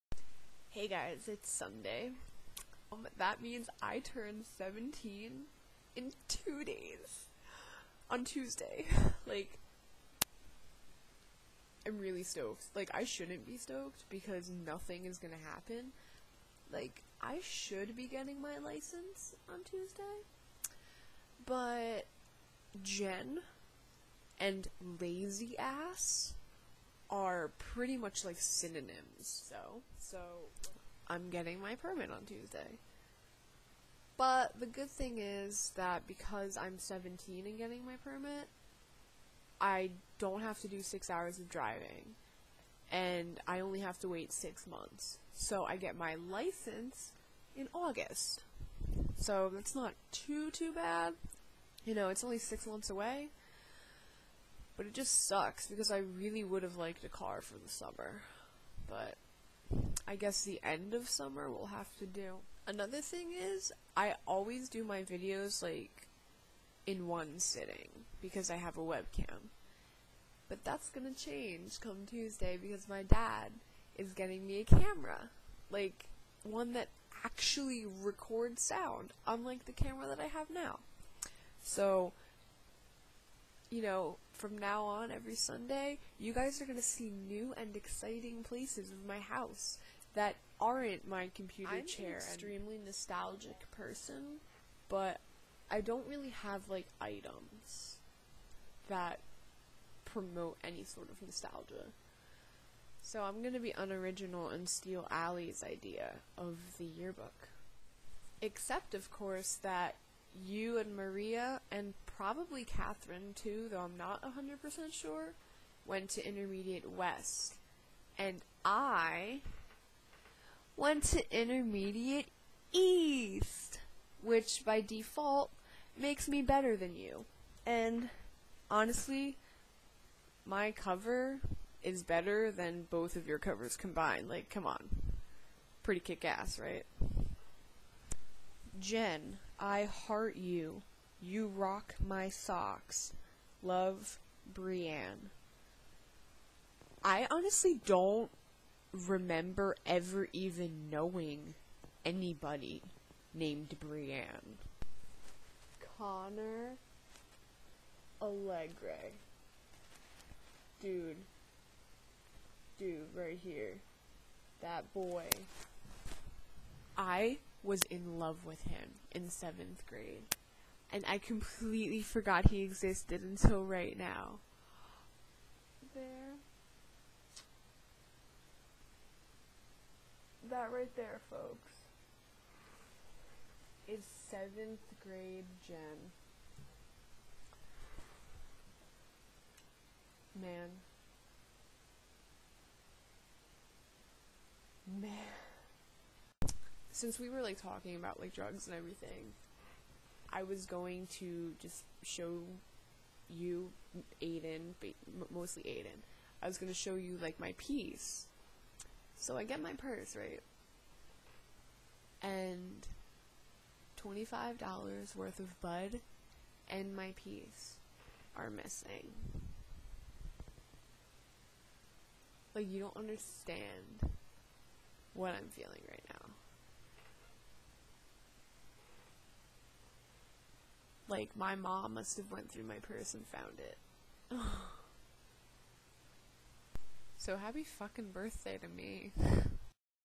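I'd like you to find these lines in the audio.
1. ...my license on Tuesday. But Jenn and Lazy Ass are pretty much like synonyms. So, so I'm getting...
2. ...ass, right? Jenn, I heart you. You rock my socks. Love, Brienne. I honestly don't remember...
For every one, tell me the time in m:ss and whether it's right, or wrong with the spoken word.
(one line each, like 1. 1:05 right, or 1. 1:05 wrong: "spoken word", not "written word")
1. 0:18 right
2. 2:16 right.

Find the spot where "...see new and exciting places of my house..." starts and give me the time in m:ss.
1:26.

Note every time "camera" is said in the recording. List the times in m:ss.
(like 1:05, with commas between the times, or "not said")
1:14, 1:19.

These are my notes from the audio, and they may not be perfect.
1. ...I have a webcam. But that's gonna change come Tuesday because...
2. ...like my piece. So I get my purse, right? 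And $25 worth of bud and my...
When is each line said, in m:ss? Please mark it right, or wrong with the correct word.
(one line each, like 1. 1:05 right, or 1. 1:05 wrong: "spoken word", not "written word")
1. 1:08 right
2. 3:27 right.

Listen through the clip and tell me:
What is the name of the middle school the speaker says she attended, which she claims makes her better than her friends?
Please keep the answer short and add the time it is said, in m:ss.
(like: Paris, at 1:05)
Intermediate East, at 2:01.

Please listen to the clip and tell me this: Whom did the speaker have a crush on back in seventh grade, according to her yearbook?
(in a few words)
Connor Allegre.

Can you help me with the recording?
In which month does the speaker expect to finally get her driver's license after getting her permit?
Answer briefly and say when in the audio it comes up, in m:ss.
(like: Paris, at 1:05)
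August, at 0:47.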